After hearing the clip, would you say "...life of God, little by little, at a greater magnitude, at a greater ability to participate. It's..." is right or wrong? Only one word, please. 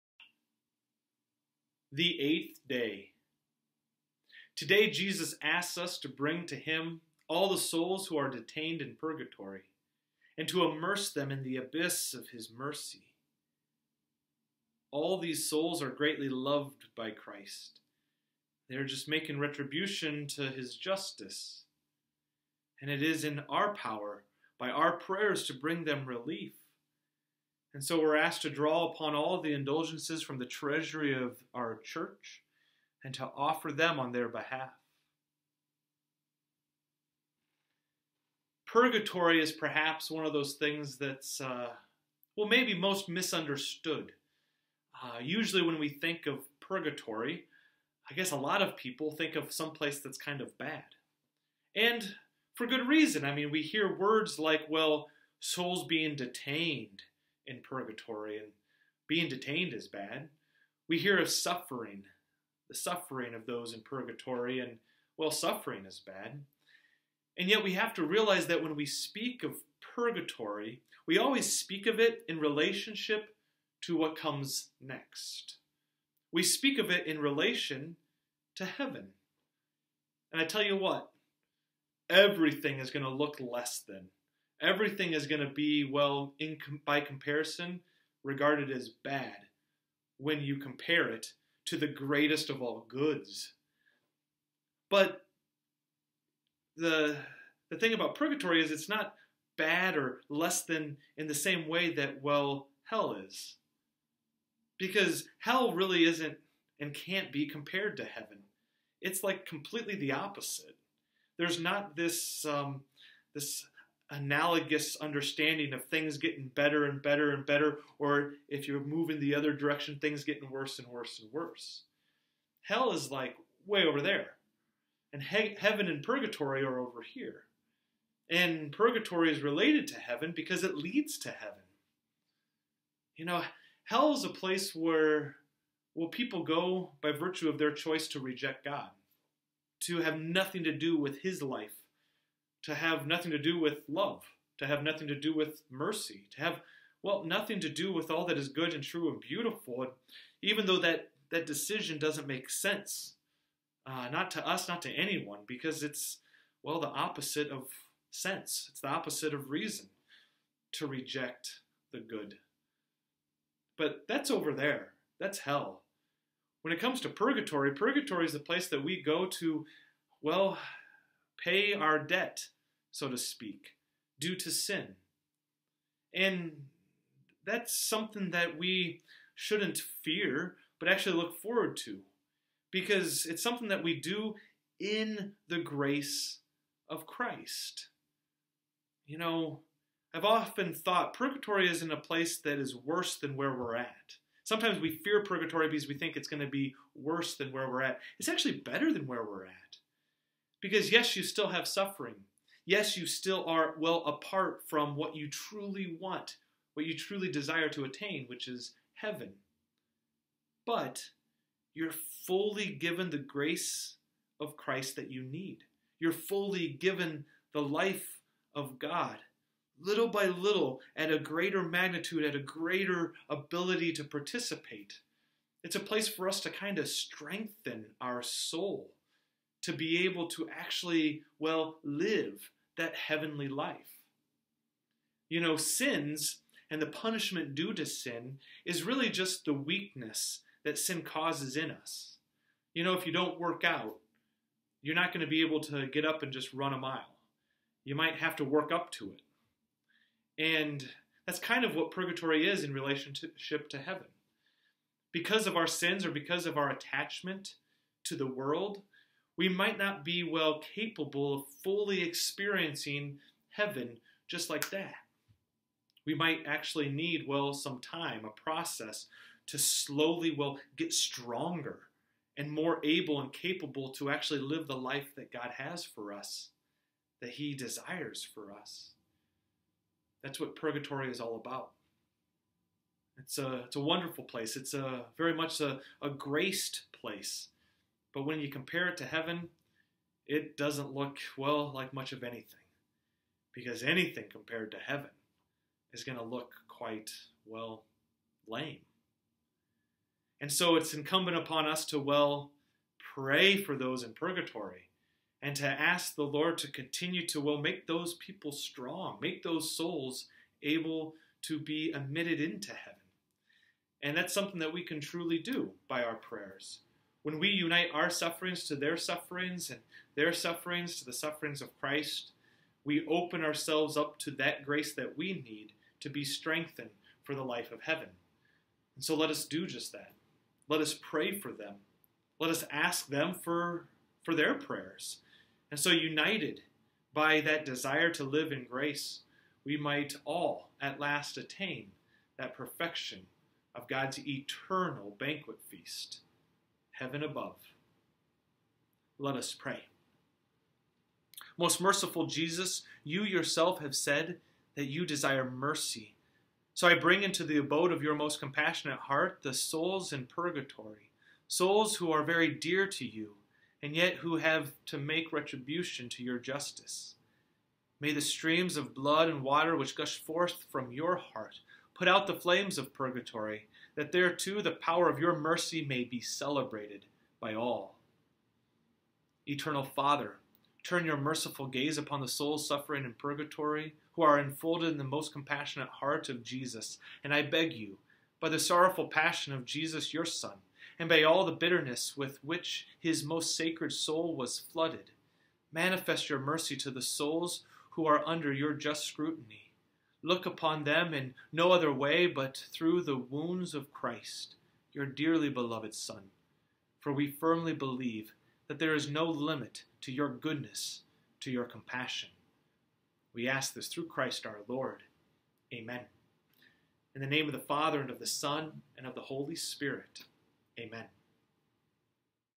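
right.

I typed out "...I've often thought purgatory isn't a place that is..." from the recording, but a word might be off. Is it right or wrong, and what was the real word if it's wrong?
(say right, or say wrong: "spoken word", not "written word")
right.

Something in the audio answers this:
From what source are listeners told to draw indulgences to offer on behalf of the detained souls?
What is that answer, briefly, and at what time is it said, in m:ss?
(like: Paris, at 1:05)
treasury of our church, at 0:30.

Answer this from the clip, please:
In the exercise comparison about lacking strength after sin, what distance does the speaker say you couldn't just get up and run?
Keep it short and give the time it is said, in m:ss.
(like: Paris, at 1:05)
a mile, at 4:06.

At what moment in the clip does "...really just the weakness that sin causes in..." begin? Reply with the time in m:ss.
3:58.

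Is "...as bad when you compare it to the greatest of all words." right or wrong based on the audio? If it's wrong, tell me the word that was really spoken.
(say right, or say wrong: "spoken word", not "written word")
wrong: "goods", not "words".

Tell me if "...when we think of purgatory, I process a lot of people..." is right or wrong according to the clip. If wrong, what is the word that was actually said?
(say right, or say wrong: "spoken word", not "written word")
wrong: "guess", not "process".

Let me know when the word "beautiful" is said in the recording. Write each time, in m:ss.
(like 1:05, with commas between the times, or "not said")
2:29.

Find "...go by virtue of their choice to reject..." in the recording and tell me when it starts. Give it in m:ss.
2:16.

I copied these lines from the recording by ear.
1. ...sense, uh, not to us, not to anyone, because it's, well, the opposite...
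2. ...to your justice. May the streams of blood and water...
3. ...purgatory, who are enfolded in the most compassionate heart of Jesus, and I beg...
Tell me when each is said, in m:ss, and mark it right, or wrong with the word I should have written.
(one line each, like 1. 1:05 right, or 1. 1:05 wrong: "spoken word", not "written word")
1. 2:32 right
2. 6:06 right
3. 6:23 right.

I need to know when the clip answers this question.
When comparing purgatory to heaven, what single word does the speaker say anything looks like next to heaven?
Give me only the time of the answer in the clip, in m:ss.
4:58.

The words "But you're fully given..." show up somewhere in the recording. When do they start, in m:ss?
3:30.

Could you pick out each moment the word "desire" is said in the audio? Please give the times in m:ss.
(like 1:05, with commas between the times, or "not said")
3:27, 4:37, 5:37, 5:55.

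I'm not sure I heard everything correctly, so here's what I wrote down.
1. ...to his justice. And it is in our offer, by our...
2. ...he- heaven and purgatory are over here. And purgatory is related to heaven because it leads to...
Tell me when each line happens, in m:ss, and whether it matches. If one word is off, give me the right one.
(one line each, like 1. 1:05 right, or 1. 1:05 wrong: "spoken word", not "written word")
1. 0:20 wrong: "power", not "offer"
2. 2:05 right.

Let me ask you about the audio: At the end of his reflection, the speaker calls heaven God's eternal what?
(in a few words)
banquet.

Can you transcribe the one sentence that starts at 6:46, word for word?
For we firmly believe that there is no limit to your goodness, to your compassion.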